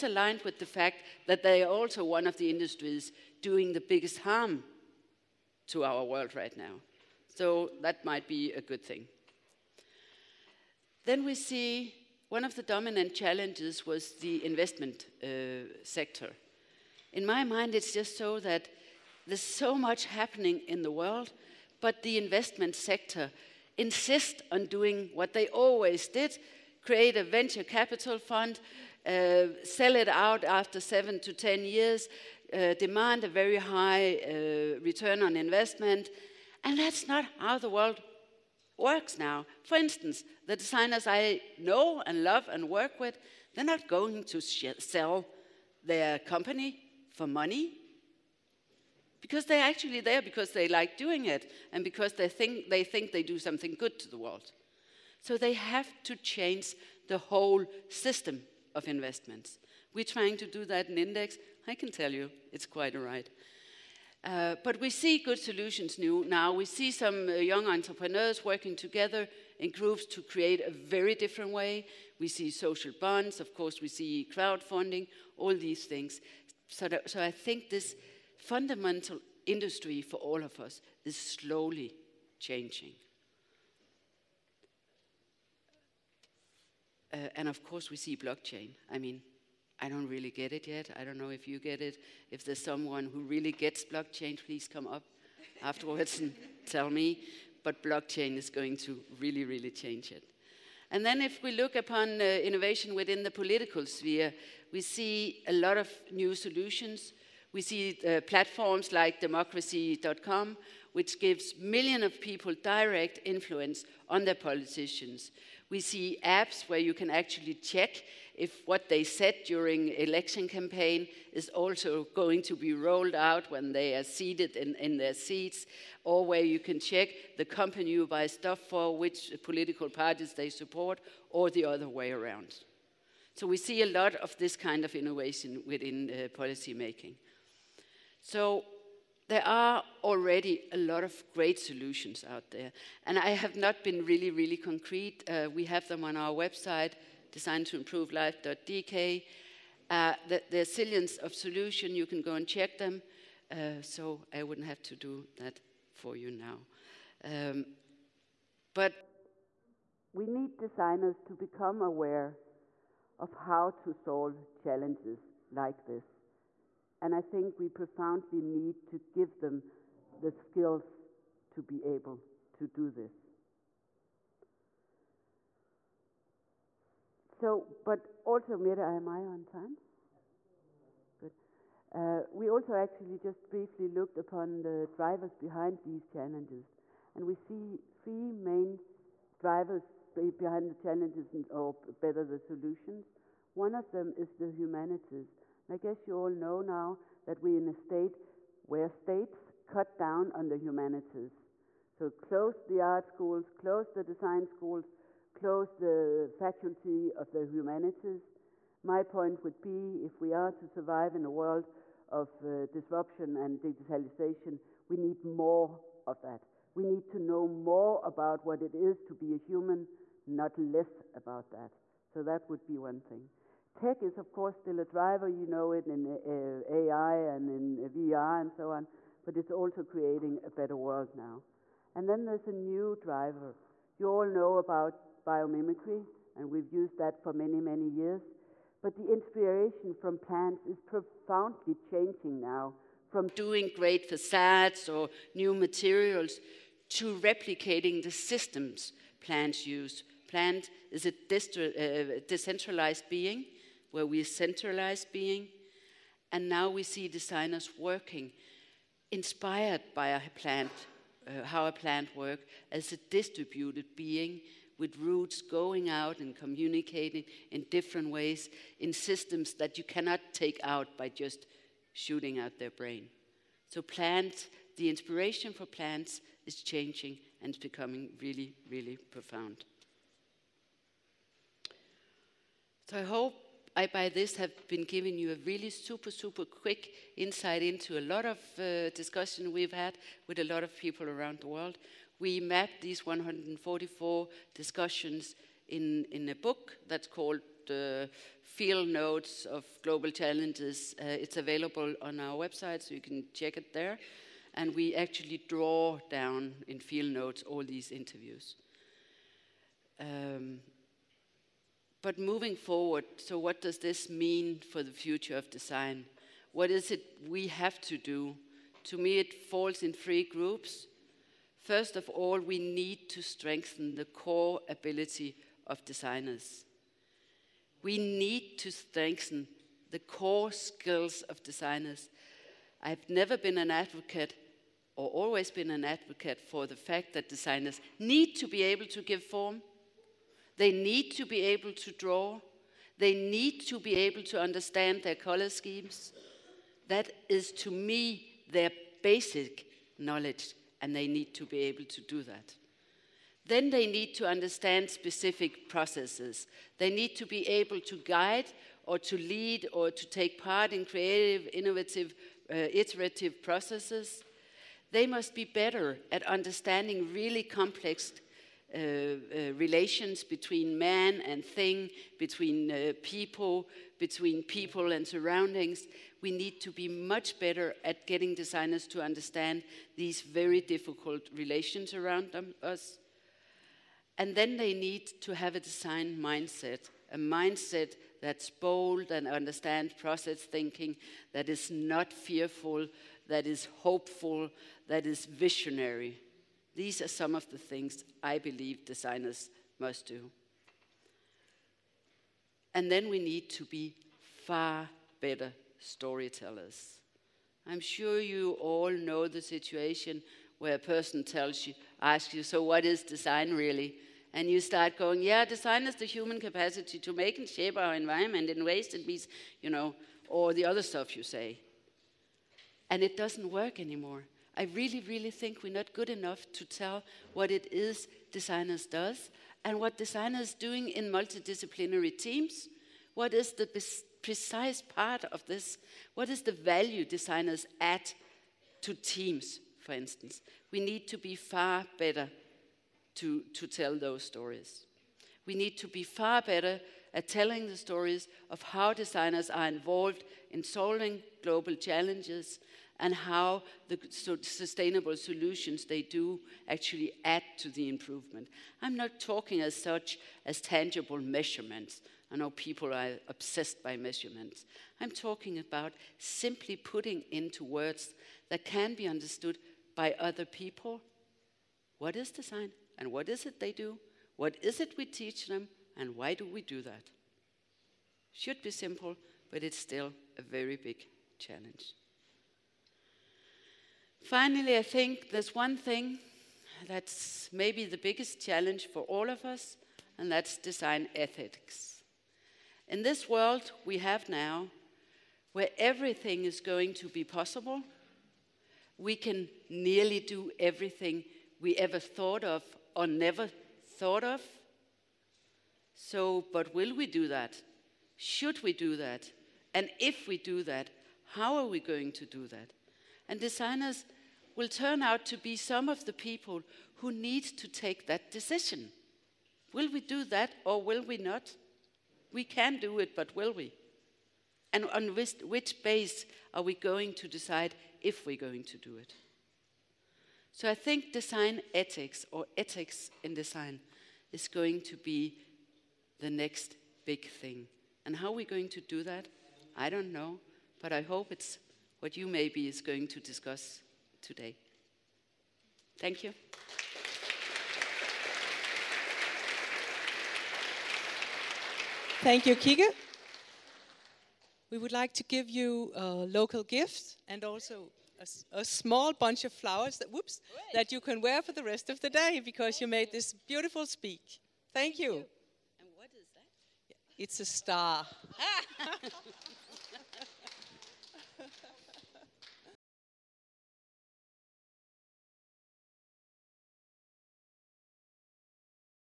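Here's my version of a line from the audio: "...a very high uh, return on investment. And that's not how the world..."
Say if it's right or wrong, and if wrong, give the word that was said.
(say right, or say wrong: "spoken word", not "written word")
right.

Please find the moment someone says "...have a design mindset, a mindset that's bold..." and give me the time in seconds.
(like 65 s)
385 s.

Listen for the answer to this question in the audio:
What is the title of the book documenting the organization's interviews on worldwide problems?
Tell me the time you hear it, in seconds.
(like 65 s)
298 s.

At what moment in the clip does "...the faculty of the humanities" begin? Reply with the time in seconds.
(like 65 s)
205 s.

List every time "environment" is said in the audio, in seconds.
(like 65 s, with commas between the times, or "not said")
417 s.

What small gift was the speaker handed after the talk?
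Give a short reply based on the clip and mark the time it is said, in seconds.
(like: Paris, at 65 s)
A star, at 567 s.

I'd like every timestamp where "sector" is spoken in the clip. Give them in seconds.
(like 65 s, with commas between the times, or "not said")
15 s, 22 s.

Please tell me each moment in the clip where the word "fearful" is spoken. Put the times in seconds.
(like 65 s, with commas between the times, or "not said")
392 s.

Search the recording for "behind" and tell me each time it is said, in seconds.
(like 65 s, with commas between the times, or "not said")
185 s, 190 s.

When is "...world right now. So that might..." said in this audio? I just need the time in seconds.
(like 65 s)
6 s.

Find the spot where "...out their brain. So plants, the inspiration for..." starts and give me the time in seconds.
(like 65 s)
272 s.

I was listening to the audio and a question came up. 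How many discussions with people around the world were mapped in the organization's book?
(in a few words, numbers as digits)
144.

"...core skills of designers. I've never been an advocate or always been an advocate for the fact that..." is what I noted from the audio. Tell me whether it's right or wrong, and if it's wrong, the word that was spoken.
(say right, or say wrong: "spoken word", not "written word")
right.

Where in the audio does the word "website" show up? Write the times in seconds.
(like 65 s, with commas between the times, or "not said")
146 s, 302 s.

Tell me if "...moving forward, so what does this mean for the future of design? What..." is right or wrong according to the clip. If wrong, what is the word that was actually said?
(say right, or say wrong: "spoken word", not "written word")
right.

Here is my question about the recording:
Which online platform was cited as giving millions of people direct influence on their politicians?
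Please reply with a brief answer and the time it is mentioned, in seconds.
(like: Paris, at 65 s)
democracy.com, at 109 s.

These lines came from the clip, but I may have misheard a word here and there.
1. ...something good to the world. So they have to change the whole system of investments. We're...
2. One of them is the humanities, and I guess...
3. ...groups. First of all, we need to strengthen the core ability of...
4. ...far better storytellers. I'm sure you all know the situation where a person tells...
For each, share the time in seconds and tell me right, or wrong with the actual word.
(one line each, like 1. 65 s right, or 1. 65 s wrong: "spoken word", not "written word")
1. 53 s right
2. 193 s right
3. 320 s right
4. 404 s right.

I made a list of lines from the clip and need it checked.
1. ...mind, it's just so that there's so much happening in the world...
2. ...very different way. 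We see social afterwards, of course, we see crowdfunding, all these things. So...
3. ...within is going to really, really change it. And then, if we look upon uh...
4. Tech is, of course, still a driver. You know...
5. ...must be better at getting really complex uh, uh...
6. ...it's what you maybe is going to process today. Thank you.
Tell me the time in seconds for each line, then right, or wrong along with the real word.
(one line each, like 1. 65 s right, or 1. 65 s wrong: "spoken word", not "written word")
1. 17 s right
2. 70 s wrong: "bonds", not "afterwards"
3. 97 s wrong: "blockchain", not "within"
4. 223 s right
5. 365 s wrong: "understanding", not "getting"
6. 541 s wrong: "discuss", not "process".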